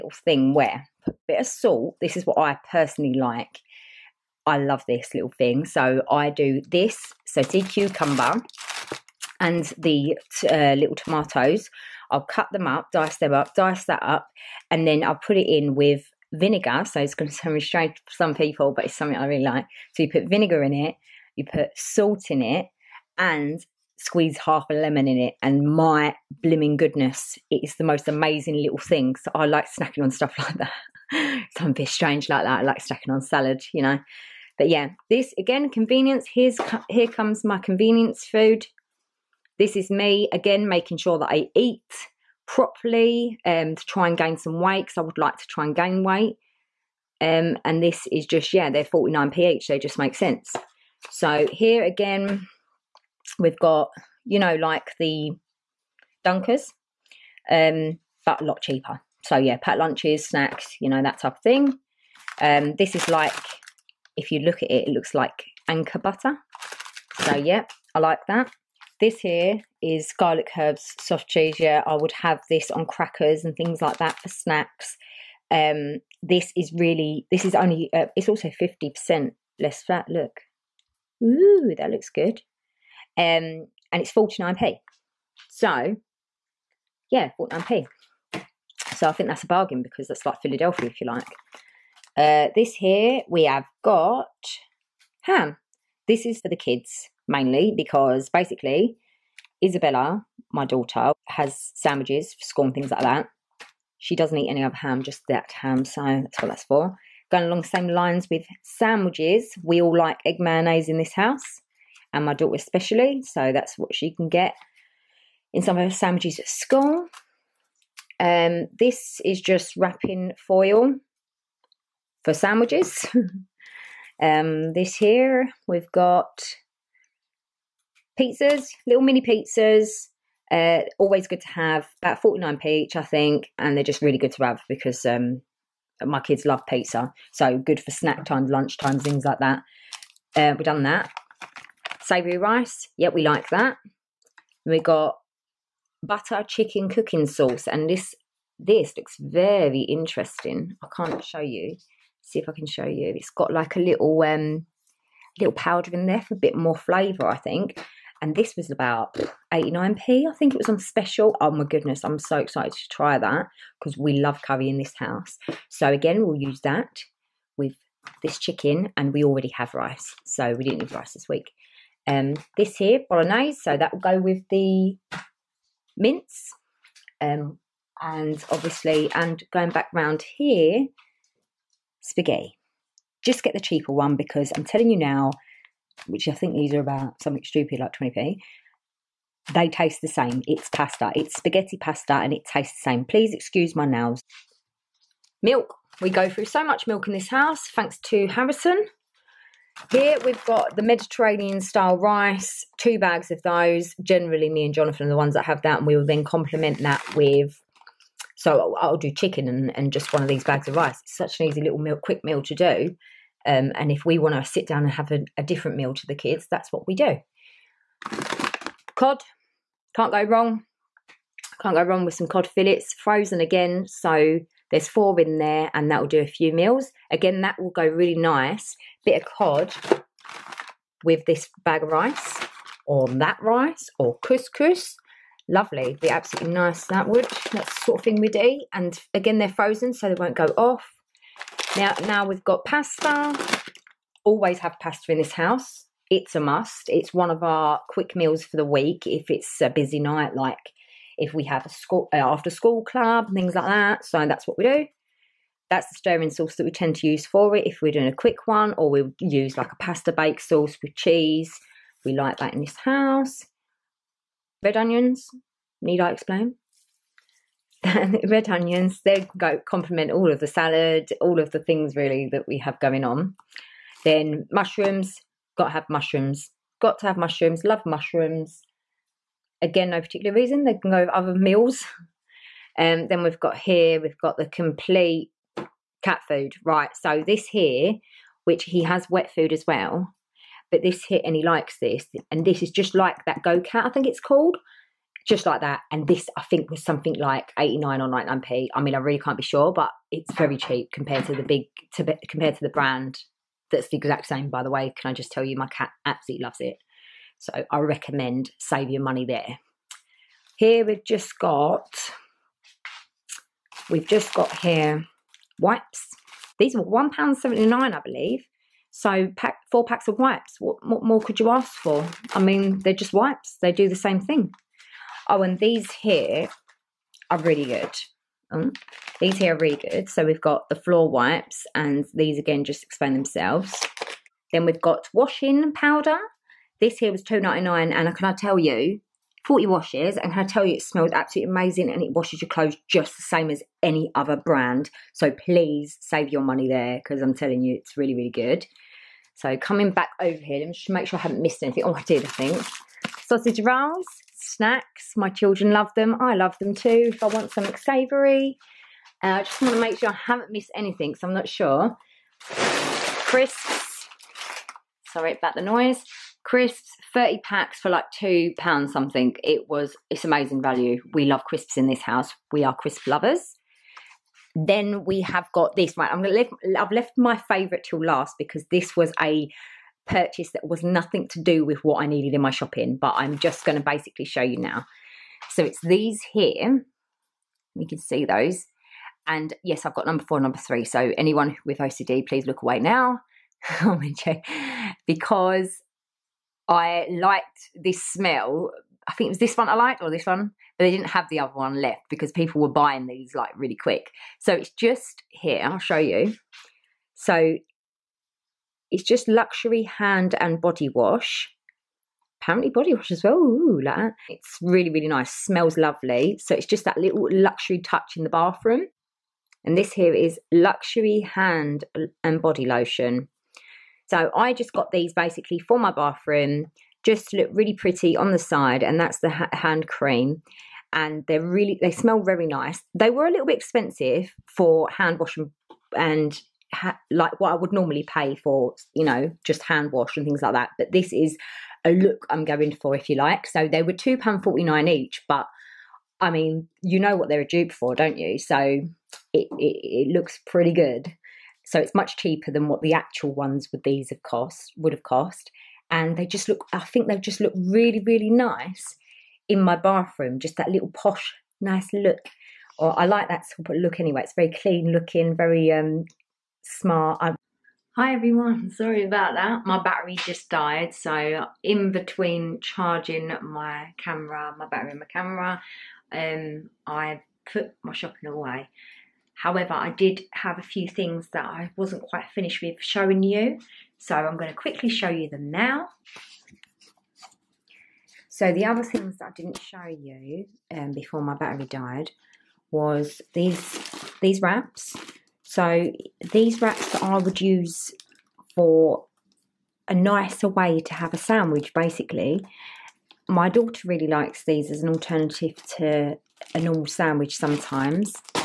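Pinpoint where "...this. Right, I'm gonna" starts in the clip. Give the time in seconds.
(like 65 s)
375 s.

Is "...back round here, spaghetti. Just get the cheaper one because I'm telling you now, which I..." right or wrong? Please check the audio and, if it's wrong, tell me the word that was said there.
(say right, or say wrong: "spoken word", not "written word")
right.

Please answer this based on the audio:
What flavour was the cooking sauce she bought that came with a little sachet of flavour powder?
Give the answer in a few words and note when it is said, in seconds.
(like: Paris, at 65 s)
butter chicken, at 146 s.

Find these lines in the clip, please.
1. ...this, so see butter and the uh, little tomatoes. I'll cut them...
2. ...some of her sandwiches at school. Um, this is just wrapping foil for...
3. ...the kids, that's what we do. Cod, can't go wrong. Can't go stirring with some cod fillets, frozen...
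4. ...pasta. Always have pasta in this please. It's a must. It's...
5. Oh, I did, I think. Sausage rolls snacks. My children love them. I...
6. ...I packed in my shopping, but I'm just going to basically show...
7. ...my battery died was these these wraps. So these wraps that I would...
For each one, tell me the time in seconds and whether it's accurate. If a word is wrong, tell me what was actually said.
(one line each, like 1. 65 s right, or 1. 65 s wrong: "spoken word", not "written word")
1. 6 s wrong: "cucumber", not "butter"
2. 115 s right
3. 216 s wrong: "wrong", not "stirring"
4. 242 s wrong: "house", not "please"
5. 351 s right
6. 382 s wrong: "needed", not "packed"
7. 491 s right.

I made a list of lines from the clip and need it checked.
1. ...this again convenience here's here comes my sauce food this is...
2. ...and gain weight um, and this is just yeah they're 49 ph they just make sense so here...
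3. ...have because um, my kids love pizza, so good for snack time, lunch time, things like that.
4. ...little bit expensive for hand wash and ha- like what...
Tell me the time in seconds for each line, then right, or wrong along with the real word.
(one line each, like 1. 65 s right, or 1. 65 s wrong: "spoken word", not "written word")
1. 35 s wrong: "convenience", not "sauce"
2. 45 s right
3. 134 s right
4. 433 s right.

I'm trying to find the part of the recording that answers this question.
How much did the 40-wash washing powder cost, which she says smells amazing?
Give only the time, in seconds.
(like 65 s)
337 s.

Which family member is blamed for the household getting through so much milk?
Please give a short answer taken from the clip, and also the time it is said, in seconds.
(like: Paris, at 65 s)
Harrison, at 198 s.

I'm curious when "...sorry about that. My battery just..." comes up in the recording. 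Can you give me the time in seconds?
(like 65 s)
468 s.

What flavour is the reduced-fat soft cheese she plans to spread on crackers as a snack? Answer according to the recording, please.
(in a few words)
garlic herbs.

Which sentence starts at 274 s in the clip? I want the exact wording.
Then mushrooms, got to have mushrooms.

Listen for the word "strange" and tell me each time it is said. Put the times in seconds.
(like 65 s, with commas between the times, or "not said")
17 s, 31 s.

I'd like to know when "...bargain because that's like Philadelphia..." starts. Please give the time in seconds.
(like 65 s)
89 s.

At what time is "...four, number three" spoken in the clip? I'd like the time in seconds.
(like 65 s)
390 s.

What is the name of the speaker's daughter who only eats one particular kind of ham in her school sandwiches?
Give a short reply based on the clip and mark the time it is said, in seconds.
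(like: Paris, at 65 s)
Isabella, at 99 s.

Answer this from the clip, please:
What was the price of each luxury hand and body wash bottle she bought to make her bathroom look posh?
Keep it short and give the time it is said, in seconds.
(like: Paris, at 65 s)
£2.49, at 443 s.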